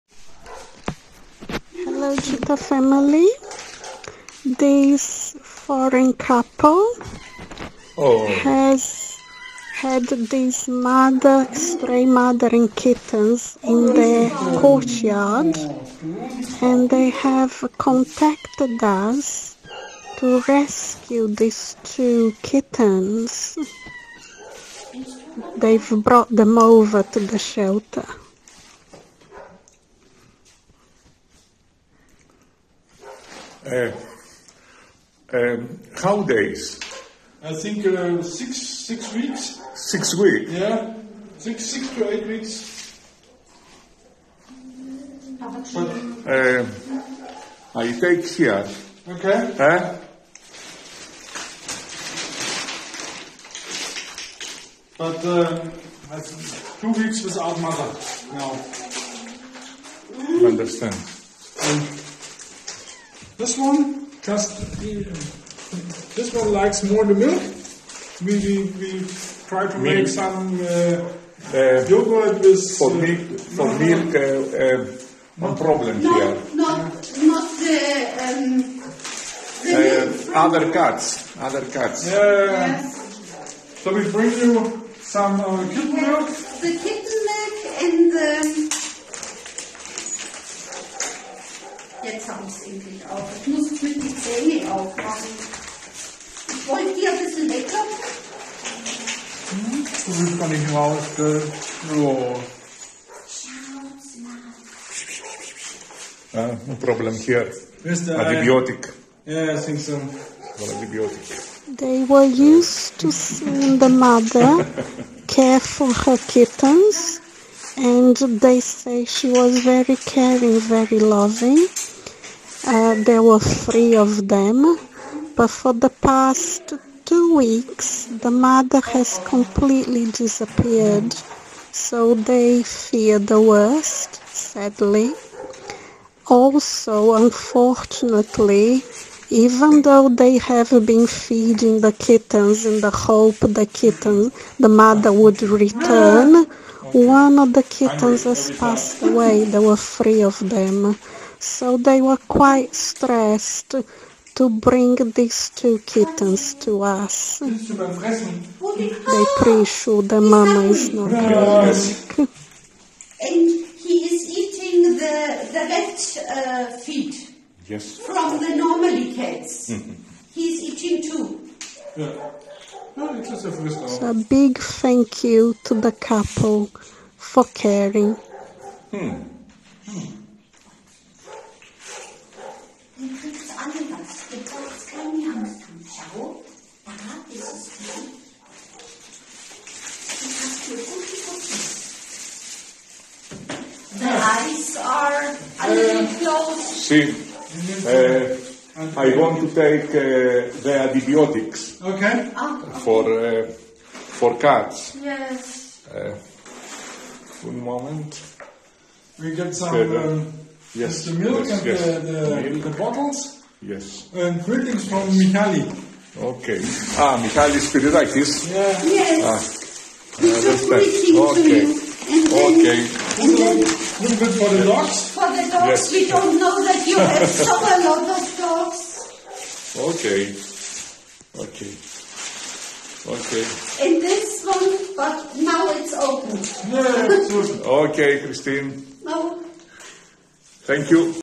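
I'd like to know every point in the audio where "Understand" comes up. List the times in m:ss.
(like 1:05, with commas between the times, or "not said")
1:00.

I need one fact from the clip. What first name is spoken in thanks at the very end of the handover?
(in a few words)
Christine.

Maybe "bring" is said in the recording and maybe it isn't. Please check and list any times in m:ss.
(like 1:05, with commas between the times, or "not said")
1:24, 2:34.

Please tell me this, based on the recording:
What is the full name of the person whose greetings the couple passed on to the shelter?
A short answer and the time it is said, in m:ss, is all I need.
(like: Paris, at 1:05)
Michalis Spiridakis, at 3:37.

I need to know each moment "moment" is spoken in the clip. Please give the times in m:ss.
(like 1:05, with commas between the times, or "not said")
3:27.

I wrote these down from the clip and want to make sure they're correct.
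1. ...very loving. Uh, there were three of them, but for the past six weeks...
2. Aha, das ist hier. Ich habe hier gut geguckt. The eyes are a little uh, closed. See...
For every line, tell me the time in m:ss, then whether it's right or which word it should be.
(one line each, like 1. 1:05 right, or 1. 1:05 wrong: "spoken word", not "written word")
1. 2:00 wrong: "two", not "six"
2. 3:06 right.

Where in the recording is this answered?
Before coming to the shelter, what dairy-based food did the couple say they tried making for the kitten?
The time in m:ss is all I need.
1:11.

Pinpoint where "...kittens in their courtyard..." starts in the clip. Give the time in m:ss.
0:12.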